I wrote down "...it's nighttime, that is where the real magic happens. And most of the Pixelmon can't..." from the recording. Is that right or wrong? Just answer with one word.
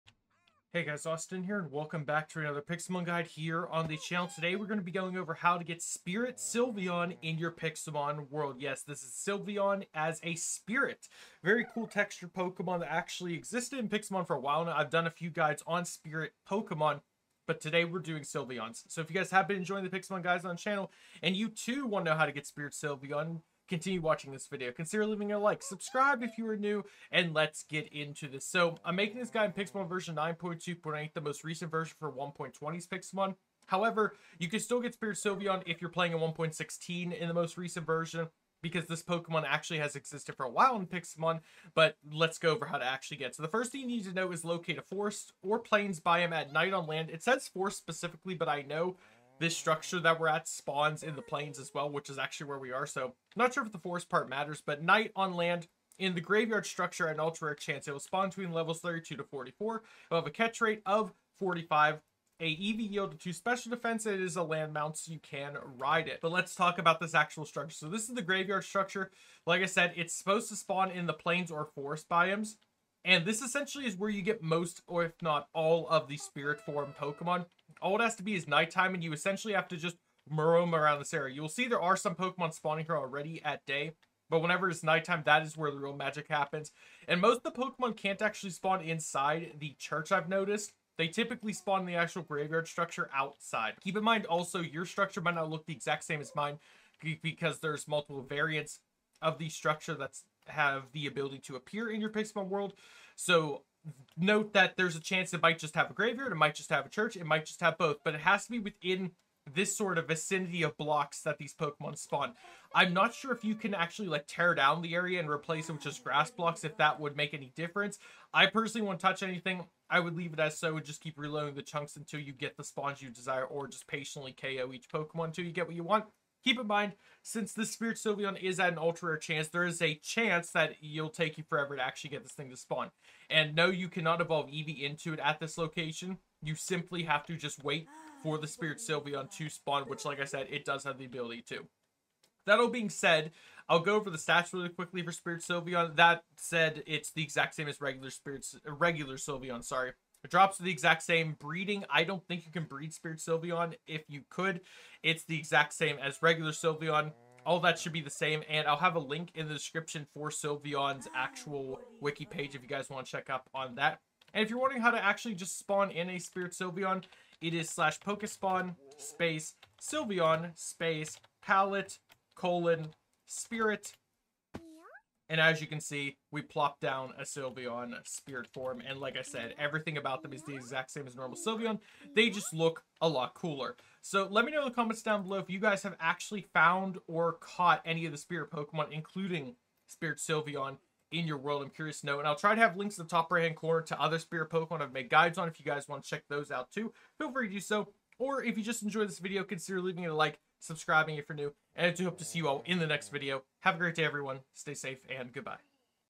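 wrong.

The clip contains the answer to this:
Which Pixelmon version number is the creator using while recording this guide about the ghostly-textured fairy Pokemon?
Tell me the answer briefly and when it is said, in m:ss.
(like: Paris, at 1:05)
9.2.8, at 0:30.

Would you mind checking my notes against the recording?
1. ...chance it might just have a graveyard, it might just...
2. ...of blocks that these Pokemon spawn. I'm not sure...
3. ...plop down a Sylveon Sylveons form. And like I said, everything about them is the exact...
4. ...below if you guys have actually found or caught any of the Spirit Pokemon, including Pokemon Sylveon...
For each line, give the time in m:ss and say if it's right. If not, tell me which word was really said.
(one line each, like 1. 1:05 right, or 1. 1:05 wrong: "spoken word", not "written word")
1. 1:45 right
2. 1:50 right
3. 2:56 wrong: "Spirit", not "Sylveons"
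4. 3:05 wrong: "Spirit", not "Pokemon".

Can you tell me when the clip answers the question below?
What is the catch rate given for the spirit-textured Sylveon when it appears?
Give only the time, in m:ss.
1:01.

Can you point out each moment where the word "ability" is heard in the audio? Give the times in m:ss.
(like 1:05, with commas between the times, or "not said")
1:41, 2:21.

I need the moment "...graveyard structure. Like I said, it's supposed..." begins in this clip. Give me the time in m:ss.
1:08.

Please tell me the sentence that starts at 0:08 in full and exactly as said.
Yes, this is Sylveon as a spirit.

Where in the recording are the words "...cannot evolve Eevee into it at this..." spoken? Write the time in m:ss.
2:13.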